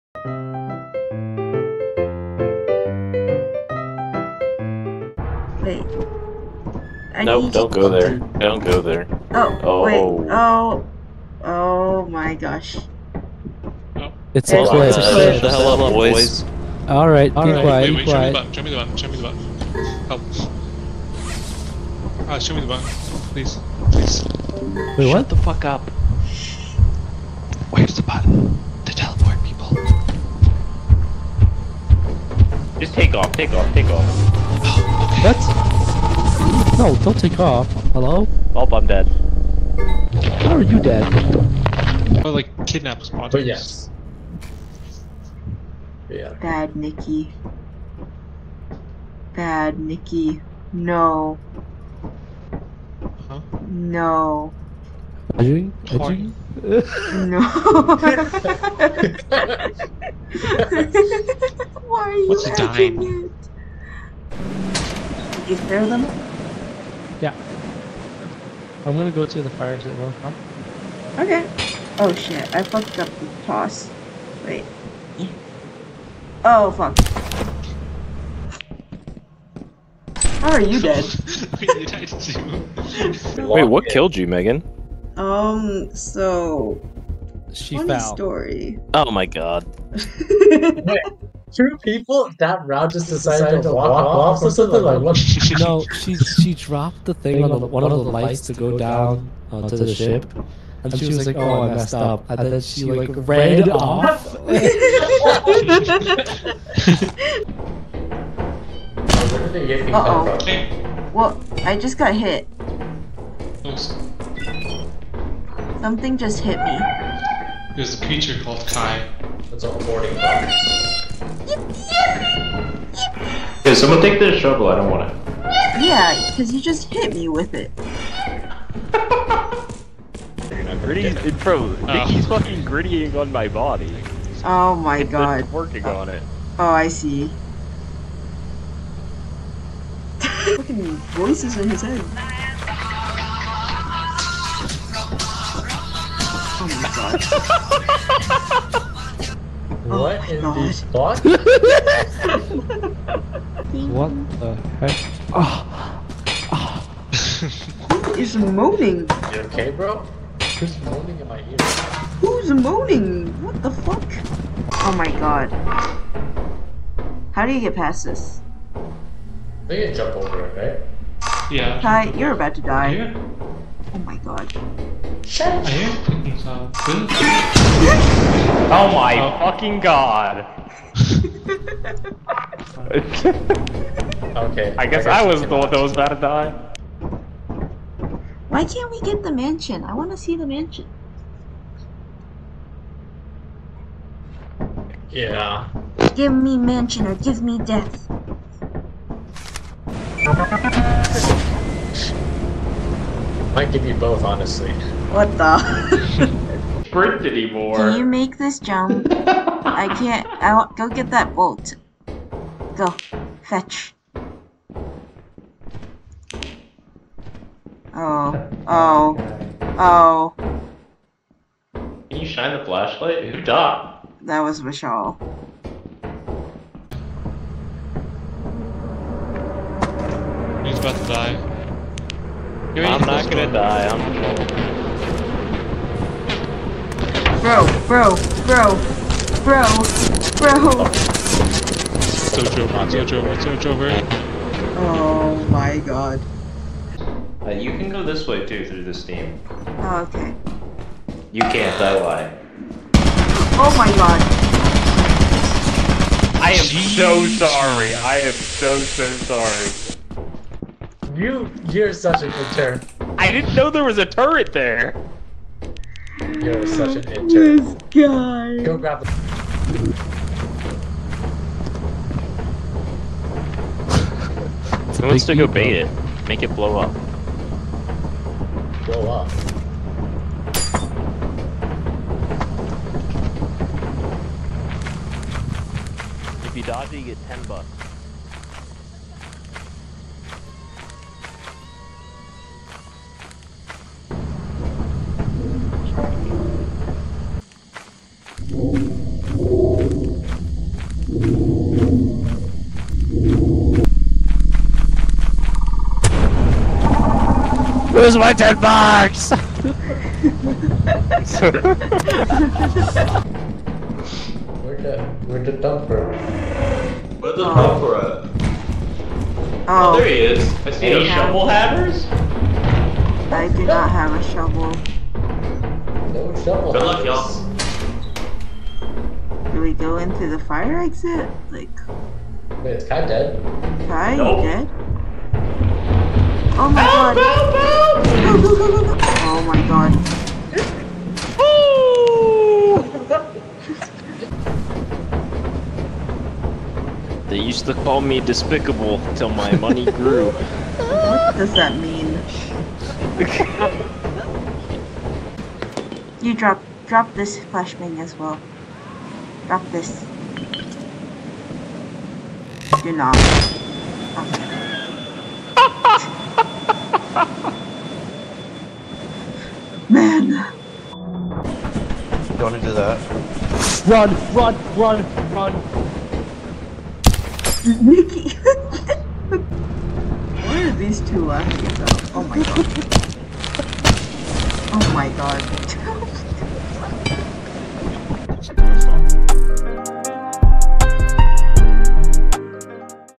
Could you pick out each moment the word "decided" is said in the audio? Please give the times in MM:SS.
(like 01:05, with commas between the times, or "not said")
01:33.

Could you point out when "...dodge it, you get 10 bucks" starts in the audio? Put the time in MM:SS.
04:46.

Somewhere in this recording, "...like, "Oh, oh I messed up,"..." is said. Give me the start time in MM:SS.
01:41.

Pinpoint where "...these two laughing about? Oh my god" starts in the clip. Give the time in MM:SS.
06:20.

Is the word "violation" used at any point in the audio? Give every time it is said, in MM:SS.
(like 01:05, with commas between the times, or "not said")
not said.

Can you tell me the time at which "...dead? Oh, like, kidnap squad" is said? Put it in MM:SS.
00:40.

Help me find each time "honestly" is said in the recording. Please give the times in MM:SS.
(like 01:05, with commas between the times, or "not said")
03:24.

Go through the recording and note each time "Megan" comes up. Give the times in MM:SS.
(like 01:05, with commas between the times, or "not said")
01:24.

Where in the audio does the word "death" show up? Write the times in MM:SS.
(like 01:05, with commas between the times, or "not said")
03:17.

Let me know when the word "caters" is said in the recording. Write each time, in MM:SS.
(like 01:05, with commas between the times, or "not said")
not said.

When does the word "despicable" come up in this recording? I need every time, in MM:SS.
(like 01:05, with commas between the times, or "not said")
05:48.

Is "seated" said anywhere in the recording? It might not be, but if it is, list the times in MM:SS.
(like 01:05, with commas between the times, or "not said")
not said.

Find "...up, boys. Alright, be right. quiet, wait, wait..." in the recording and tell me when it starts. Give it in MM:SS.
00:15.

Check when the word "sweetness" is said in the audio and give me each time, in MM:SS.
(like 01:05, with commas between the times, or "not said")
not said.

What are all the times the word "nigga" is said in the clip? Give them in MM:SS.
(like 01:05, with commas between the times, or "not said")
not said.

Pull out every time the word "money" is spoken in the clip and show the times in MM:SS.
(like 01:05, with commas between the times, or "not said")
05:49.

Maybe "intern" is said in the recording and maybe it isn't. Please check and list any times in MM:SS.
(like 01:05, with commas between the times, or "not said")
04:27.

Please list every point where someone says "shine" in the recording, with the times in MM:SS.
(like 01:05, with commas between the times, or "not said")
03:42.